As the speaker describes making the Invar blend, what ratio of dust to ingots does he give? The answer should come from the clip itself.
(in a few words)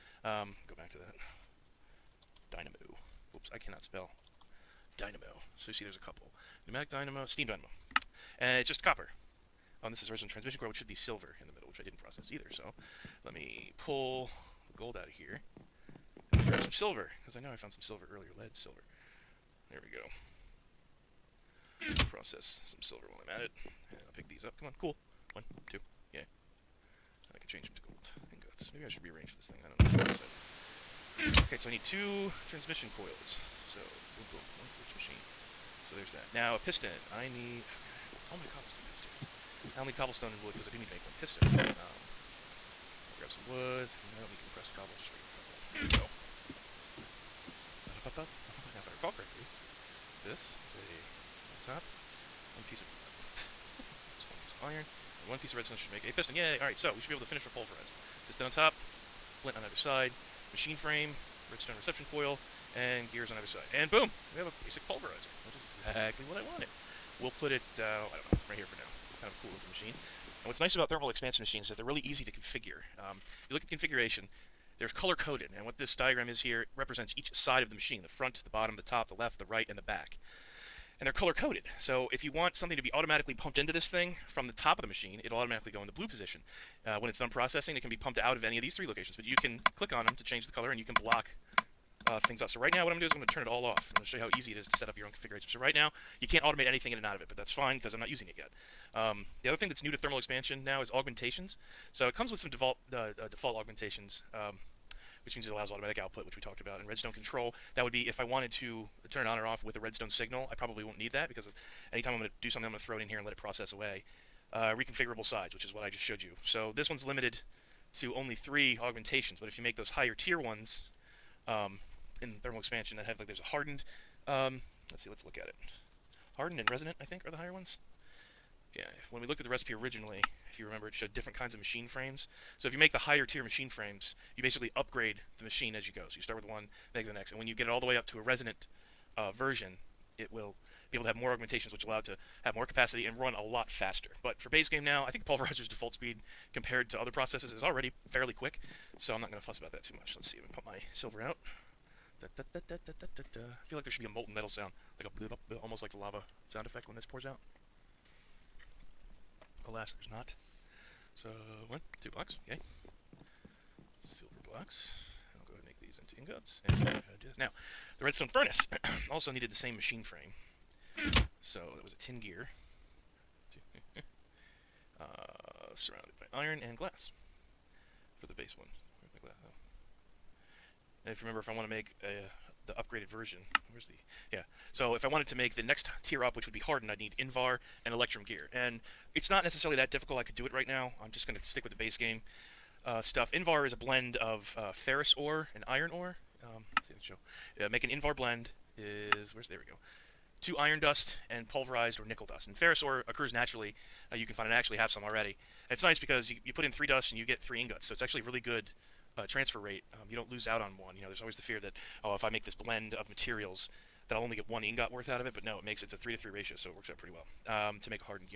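3 to 3.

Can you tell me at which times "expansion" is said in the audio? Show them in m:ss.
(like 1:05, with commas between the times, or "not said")
1:11, 1:40, 2:02.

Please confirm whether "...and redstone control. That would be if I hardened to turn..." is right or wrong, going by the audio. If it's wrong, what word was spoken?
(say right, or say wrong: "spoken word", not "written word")
wrong: "wanted", not "hardened".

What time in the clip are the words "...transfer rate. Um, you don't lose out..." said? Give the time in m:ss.
3:29.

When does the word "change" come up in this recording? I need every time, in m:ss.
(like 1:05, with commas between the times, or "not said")
0:27, 1:30.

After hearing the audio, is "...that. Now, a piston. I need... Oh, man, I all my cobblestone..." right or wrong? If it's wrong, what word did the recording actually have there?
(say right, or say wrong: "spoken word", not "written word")
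right.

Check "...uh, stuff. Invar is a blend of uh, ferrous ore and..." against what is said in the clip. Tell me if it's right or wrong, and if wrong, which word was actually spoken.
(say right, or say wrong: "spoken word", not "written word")
right.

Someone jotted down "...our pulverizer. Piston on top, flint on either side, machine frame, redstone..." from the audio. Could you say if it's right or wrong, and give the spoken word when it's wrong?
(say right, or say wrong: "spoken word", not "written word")
right.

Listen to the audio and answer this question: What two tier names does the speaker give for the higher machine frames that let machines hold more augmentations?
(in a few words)
Hardened and resonant.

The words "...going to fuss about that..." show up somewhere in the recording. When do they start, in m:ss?
2:29.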